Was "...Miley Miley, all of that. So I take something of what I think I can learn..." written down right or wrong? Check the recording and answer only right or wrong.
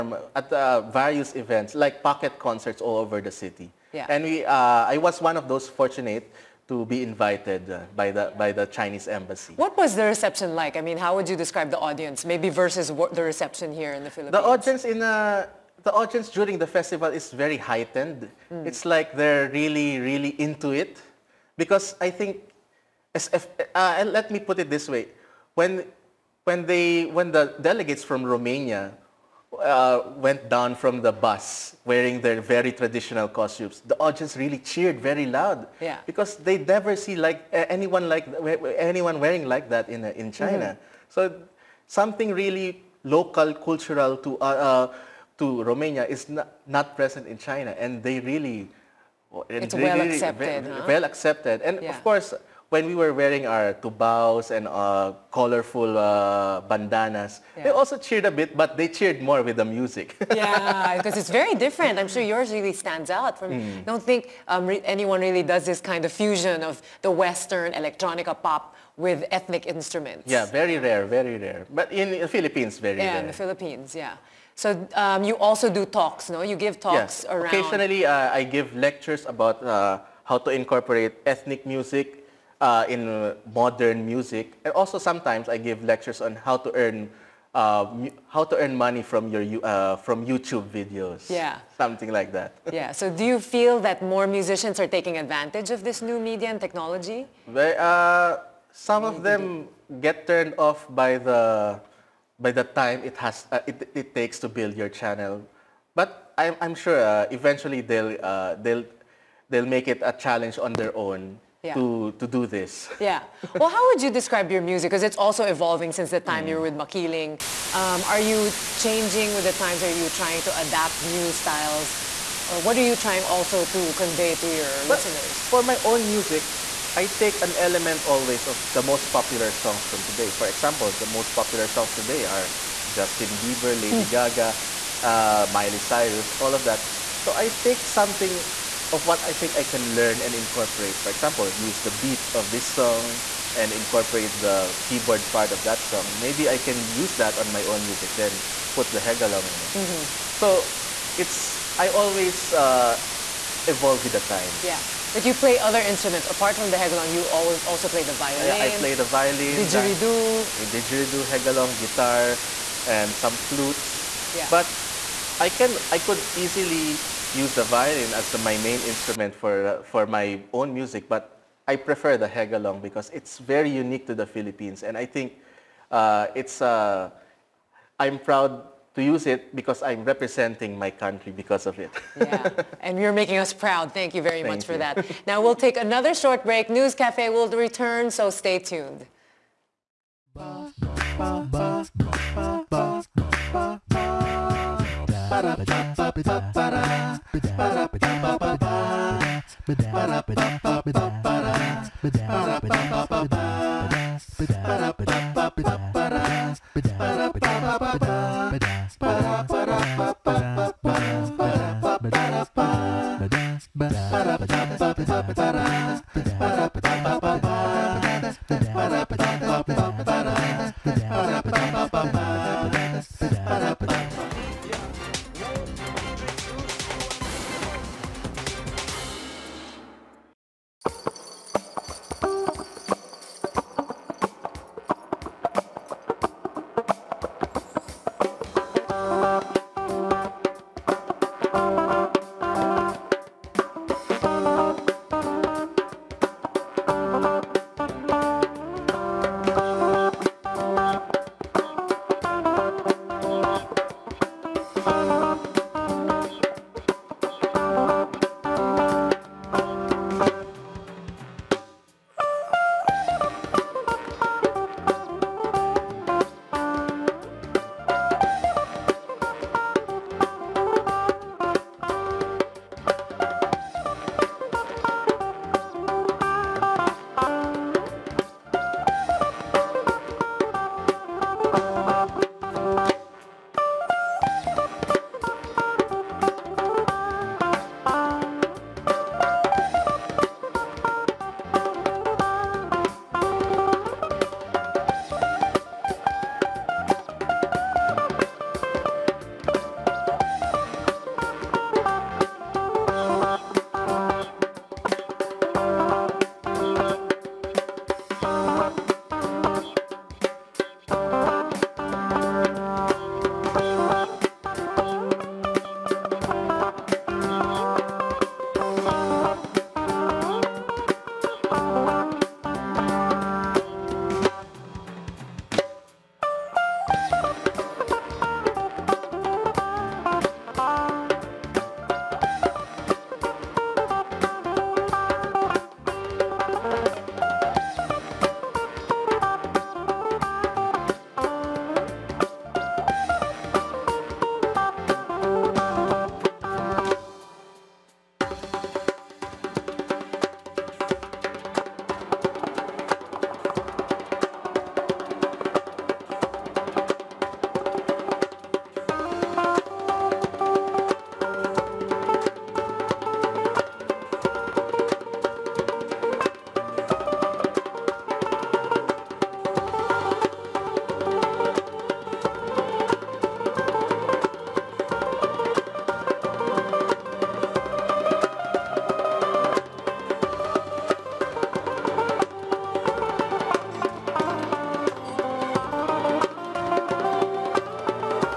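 wrong.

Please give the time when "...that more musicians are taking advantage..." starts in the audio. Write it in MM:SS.
01:33.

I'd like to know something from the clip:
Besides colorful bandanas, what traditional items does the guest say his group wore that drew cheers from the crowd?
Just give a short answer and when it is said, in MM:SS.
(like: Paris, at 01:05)
tubaos, at 00:53.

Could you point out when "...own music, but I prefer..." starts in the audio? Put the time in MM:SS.
02:50.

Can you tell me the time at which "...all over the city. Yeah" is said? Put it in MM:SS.
00:02.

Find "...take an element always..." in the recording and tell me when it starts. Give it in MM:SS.
02:07.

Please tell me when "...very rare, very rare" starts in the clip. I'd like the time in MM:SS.
01:10.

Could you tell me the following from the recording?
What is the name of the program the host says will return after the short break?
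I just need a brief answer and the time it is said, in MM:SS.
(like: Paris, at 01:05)
News Cafe, at 03:06.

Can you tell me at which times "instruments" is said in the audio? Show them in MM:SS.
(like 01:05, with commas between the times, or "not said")
01:09, 02:35, 02:48.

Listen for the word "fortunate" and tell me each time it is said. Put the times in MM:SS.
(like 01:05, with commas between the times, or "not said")
00:05.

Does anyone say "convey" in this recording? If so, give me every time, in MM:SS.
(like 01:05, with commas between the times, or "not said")
02:03.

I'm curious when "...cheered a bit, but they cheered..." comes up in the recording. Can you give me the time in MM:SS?
00:57.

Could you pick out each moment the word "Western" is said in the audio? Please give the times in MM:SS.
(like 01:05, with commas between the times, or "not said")
01:07.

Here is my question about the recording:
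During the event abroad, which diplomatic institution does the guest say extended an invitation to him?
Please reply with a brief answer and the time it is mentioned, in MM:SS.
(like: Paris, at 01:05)
Chinese embassy, at 00:08.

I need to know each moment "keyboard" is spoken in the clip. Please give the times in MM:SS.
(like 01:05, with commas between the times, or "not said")
02:24.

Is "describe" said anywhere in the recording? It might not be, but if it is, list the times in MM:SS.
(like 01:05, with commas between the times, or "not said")
00:11, 01:54.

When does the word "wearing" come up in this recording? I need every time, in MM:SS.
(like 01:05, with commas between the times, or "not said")
00:31, 00:39, 00:53.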